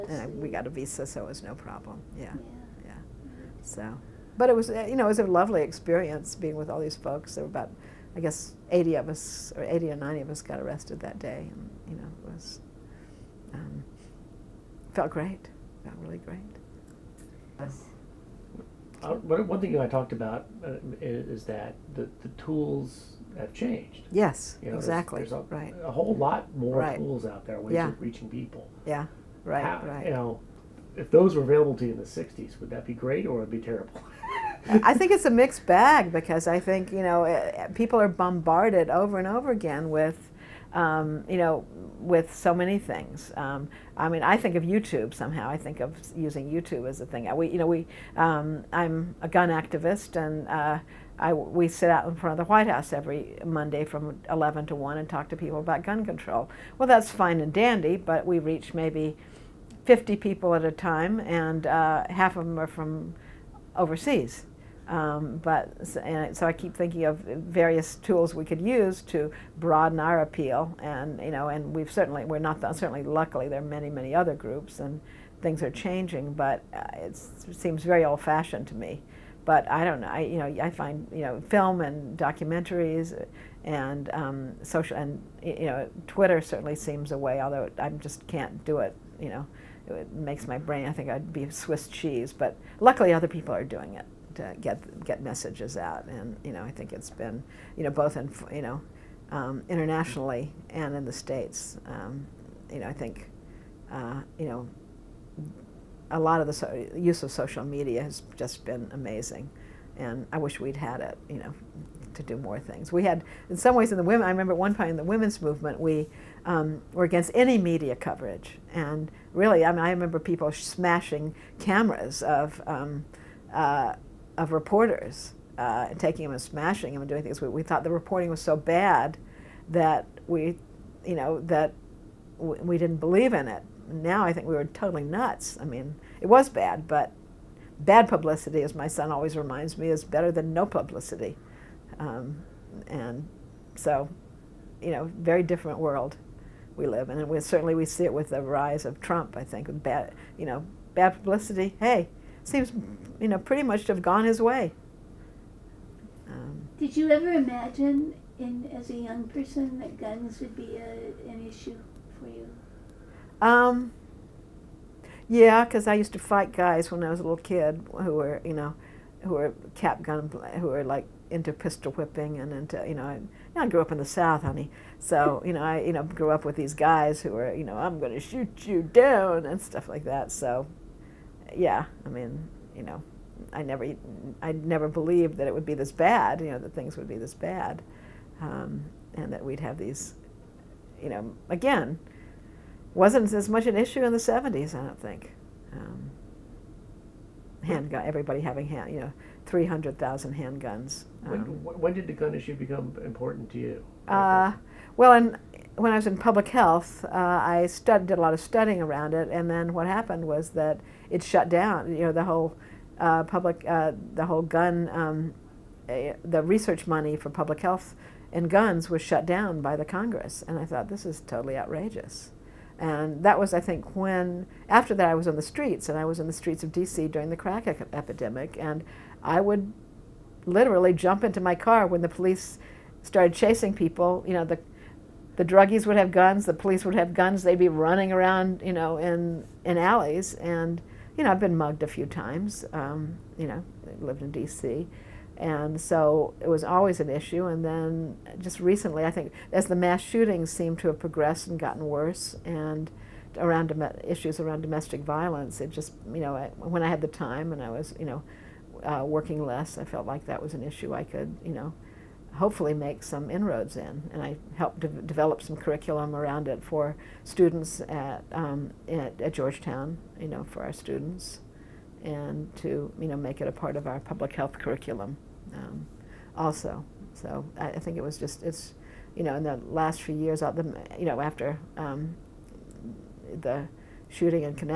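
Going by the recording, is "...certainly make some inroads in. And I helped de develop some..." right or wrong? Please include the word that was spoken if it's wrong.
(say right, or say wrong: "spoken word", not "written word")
wrong: "hopefully", not "certainly".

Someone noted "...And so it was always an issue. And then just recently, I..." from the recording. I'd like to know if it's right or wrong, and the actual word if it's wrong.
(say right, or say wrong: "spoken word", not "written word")
right.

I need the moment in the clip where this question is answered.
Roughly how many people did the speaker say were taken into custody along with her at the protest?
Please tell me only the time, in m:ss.
0:09.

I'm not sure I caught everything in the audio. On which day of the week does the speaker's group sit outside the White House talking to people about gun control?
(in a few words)
Monday.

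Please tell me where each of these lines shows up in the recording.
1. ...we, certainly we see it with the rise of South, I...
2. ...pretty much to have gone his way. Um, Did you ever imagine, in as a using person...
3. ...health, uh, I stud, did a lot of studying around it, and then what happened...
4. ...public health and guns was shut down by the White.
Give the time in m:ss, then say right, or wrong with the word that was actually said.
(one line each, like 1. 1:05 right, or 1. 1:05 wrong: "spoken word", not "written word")
1. 2:27 wrong: "Trump", not "South"
2. 2:33 wrong: "young", not "using"
3. 3:26 right
4. 3:37 wrong: "Congress", not "White".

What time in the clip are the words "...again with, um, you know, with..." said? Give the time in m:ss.
0:39.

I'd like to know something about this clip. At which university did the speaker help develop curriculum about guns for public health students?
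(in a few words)
Georgetown.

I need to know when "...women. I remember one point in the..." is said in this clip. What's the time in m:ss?
1:54.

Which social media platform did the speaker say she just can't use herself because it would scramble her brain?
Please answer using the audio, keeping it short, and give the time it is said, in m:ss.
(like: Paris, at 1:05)
Twitter, at 1:26.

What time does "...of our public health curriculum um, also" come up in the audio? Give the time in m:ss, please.
4:33.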